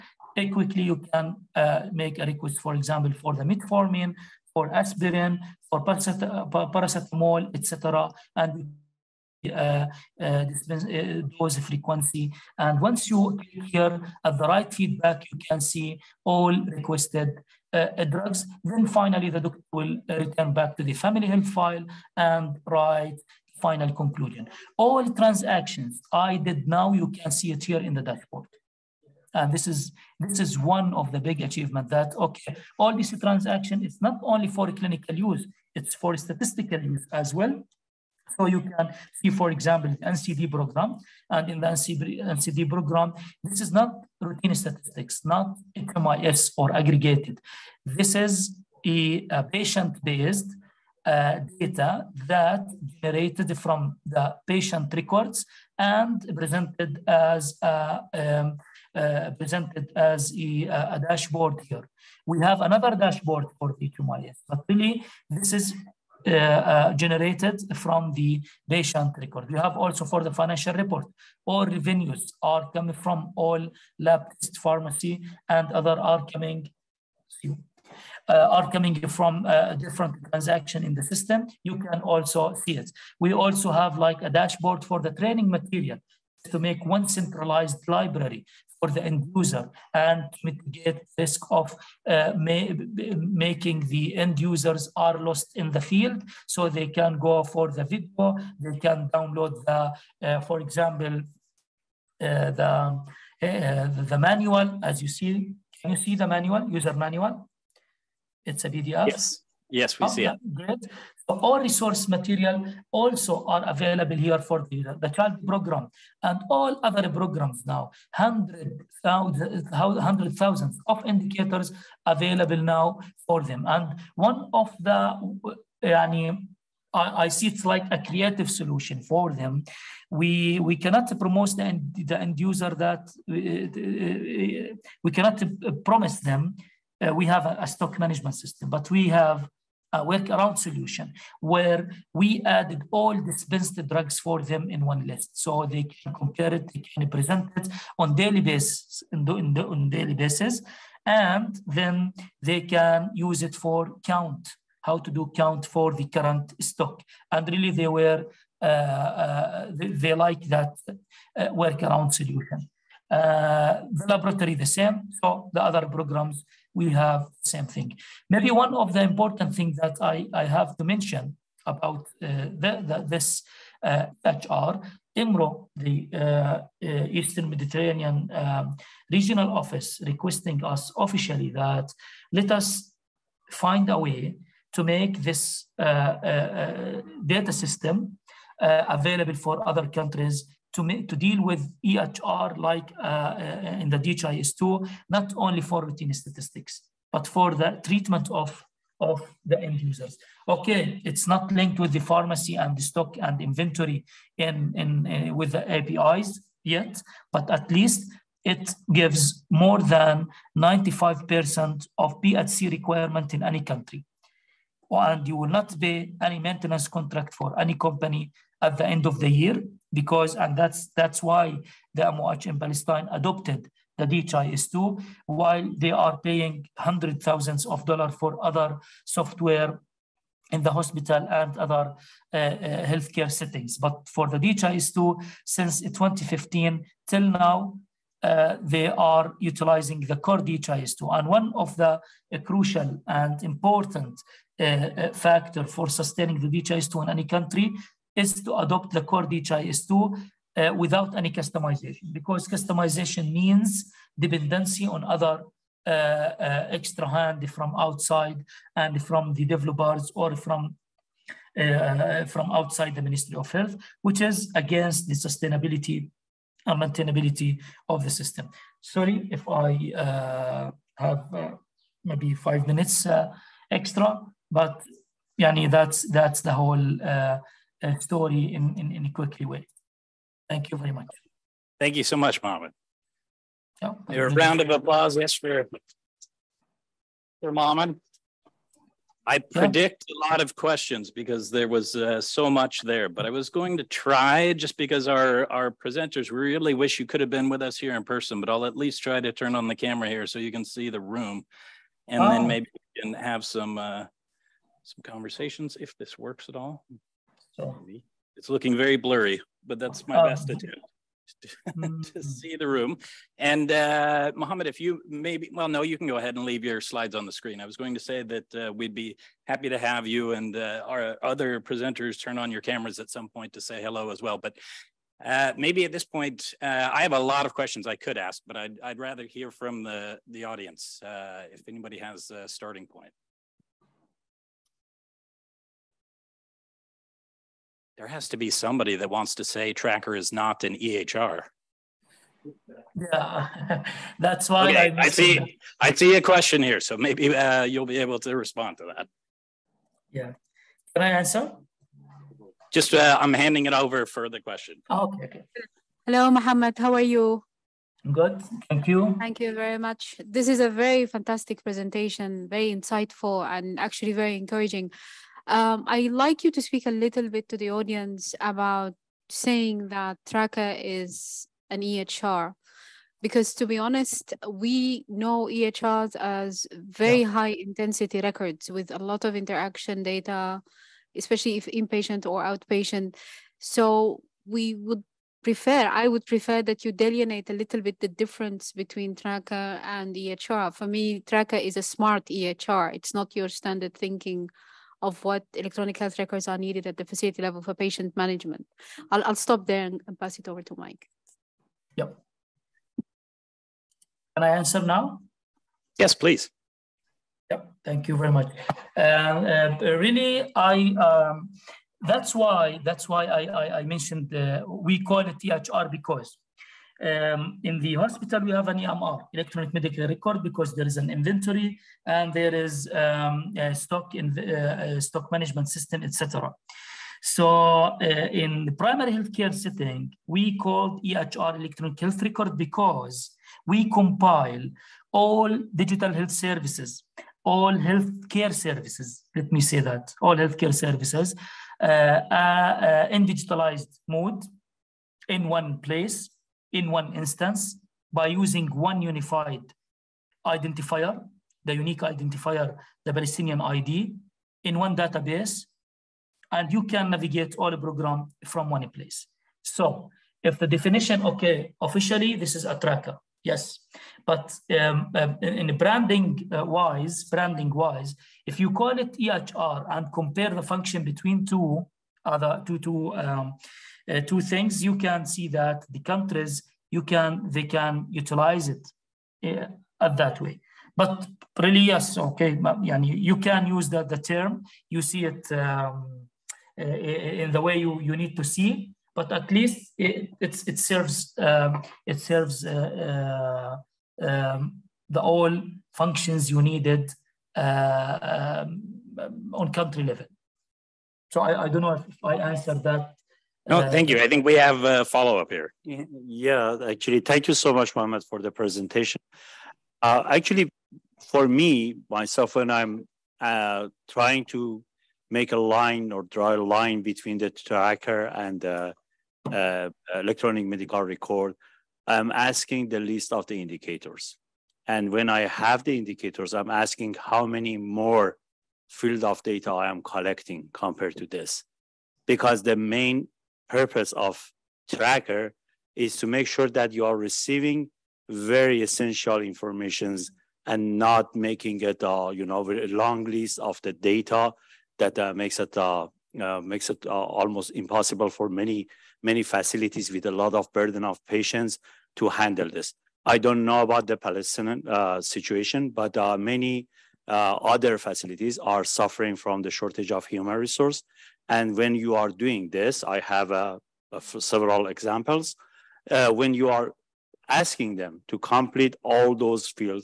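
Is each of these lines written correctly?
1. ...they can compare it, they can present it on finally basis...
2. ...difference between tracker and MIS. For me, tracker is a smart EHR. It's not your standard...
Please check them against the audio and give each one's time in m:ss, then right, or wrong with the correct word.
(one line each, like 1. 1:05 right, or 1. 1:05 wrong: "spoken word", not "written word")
1. 2:25 wrong: "daily", not "finally"
2. 6:28 wrong: "EHR", not "MIS".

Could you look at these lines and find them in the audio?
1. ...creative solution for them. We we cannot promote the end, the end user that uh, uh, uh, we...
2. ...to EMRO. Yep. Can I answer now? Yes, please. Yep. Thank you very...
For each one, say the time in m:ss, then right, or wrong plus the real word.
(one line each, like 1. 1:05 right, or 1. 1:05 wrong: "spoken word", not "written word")
1. 2:07 right
2. 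6:40 wrong: "Mike", not "EMRO".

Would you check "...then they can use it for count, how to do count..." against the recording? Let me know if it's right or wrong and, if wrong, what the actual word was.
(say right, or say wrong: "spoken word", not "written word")
right.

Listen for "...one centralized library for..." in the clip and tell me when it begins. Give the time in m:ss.
1:26.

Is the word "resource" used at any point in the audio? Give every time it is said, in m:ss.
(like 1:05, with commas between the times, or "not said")
1:51, 9:20.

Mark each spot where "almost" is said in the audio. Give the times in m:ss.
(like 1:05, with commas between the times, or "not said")
9:07.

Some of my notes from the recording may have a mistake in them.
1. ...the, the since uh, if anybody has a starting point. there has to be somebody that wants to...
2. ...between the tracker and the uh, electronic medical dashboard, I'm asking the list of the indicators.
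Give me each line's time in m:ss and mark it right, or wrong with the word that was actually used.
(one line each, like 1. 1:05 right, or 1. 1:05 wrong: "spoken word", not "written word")
1. 5:29 wrong: "audience", not "since"
2. 8:37 wrong: "record", not "dashboard".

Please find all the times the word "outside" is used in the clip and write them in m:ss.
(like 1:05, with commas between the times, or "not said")
4:17, 4:22.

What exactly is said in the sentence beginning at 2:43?
Uh, the laboratory the same, so the other programs we have same thing.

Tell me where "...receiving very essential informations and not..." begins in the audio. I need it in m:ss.
8:57.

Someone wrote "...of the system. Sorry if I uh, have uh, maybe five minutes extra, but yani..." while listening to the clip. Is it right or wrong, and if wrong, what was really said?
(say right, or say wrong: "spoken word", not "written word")
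right.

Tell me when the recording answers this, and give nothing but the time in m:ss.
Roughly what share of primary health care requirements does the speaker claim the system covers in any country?
3:29.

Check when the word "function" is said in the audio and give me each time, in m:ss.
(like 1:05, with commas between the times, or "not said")
7:50, 8:15.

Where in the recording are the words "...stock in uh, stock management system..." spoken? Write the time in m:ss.
7:03.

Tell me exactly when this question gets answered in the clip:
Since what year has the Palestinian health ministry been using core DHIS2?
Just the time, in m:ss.
3:55.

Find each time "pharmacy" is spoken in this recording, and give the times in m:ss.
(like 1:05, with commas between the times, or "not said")
1:14, 3:21.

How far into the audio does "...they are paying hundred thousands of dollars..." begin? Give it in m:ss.
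3:45.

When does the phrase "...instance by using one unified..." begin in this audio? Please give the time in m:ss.
7:27.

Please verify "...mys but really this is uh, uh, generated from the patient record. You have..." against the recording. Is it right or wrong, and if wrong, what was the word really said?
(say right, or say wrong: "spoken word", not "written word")
right.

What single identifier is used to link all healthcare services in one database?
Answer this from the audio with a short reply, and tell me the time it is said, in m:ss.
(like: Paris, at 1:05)
The Palestinian ID, at 7:33.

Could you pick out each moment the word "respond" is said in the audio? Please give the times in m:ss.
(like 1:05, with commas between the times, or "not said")
5:48.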